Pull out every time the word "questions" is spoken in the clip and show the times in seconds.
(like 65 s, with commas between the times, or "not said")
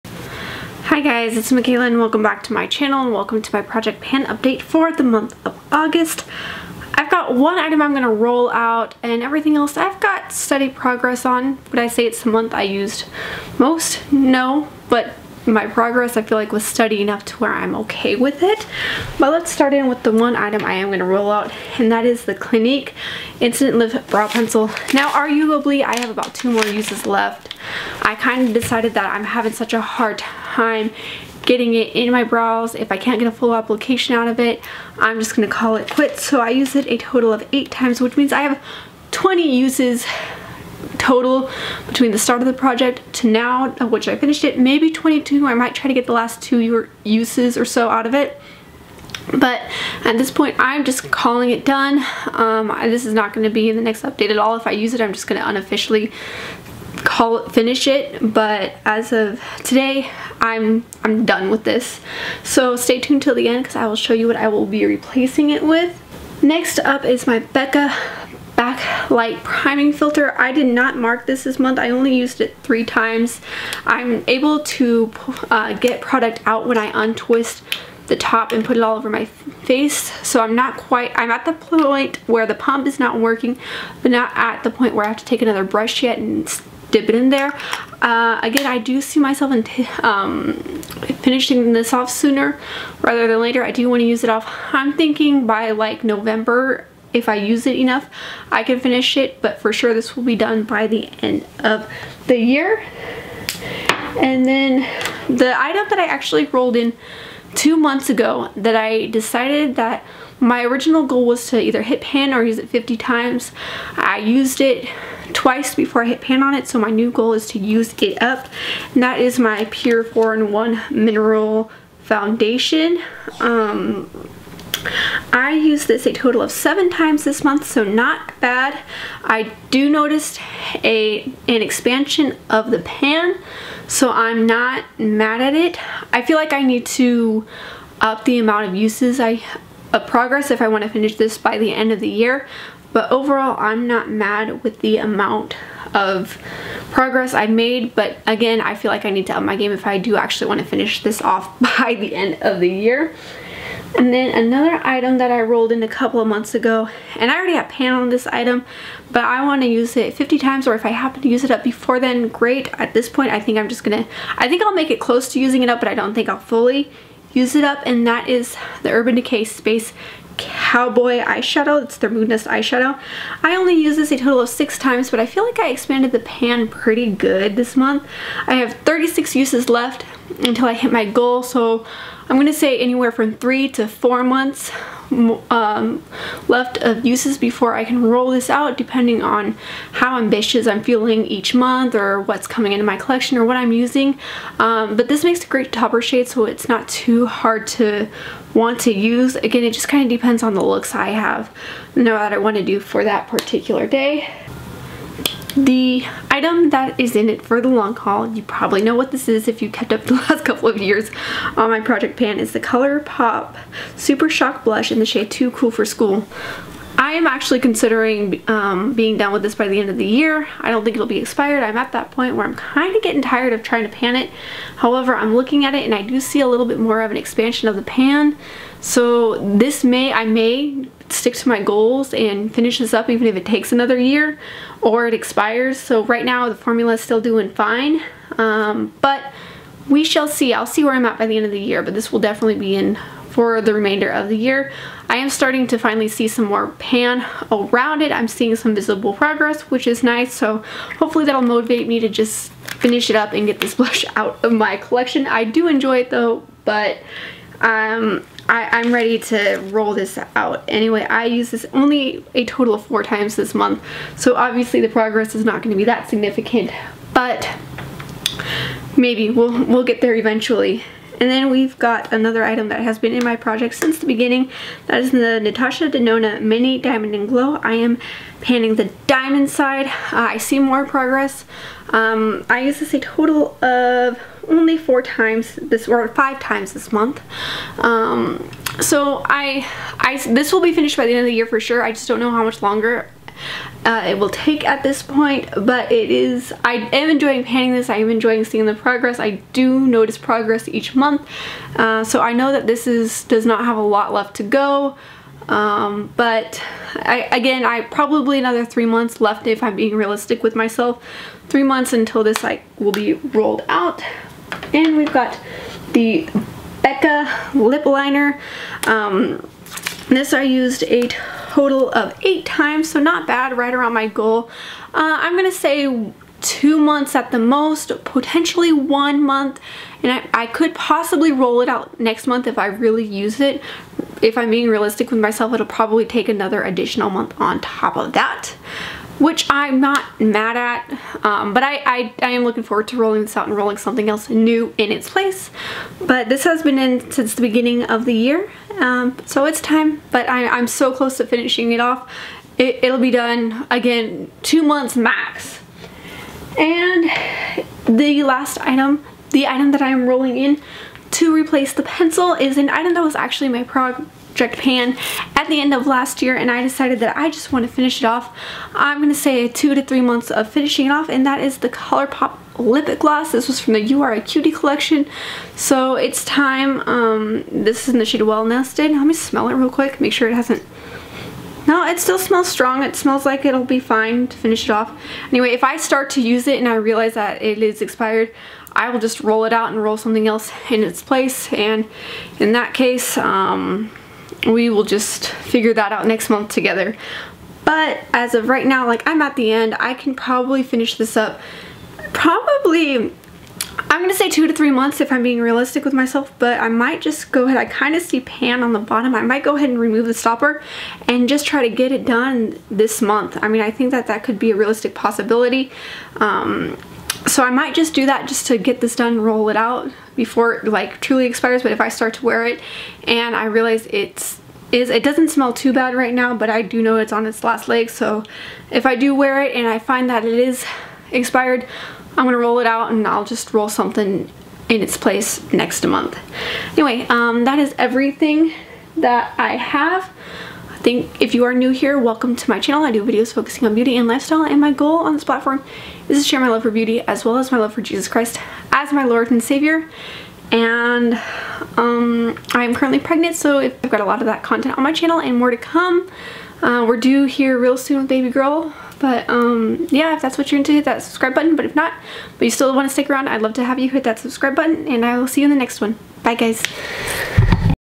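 not said.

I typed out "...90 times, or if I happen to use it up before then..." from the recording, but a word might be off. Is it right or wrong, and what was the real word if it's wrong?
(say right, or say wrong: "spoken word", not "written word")
wrong: "50", not "90".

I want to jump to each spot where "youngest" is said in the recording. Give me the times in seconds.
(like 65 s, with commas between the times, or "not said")
not said.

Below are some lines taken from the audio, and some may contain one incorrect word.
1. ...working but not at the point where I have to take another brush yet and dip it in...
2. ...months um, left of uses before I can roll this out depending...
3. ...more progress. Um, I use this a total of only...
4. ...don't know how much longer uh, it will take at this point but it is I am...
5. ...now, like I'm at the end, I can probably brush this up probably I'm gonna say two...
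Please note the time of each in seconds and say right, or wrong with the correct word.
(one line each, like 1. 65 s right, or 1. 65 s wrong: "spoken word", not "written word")
1. 83 s right
2. 184 s right
3. 280 s right
4. 292 s right
5. 398 s wrong: "finish", not "brush".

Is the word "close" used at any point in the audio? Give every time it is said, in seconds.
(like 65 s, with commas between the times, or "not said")
165 s, 350 s.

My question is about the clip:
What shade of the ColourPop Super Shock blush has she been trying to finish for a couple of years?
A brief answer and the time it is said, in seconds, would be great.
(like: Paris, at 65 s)
Too Cool for School, at 215 s.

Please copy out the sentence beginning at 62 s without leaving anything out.
So stay tuned till the end because I will show you what I will be replacing it with.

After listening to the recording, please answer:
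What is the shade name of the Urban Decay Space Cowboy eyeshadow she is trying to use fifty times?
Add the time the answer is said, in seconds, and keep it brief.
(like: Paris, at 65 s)
Moon, at 172 s.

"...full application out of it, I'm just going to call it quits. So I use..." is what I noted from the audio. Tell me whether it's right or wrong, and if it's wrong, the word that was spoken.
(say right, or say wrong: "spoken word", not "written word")
right.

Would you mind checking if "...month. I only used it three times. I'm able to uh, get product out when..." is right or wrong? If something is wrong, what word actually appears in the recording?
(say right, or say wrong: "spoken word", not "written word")
right.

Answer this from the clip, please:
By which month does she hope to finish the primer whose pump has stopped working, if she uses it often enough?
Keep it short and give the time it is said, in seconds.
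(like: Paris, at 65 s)
November, at 96 s.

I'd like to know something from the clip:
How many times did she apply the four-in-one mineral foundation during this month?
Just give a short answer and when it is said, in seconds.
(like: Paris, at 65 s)
7, at 126 s.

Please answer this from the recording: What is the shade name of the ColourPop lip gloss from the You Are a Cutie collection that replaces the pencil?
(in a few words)
Well Nested.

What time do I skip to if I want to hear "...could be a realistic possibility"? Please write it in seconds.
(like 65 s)
414 s.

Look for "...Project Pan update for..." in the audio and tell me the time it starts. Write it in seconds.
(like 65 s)
3 s.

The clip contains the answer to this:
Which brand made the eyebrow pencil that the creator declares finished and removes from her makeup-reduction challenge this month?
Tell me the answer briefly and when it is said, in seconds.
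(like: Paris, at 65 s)
Clinique, at 22 s.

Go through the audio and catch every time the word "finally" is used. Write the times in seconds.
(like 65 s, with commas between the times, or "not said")
245 s.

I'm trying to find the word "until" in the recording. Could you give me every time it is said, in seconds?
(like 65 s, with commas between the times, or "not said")
180 s, 311 s.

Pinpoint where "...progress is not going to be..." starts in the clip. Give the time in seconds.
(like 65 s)
264 s.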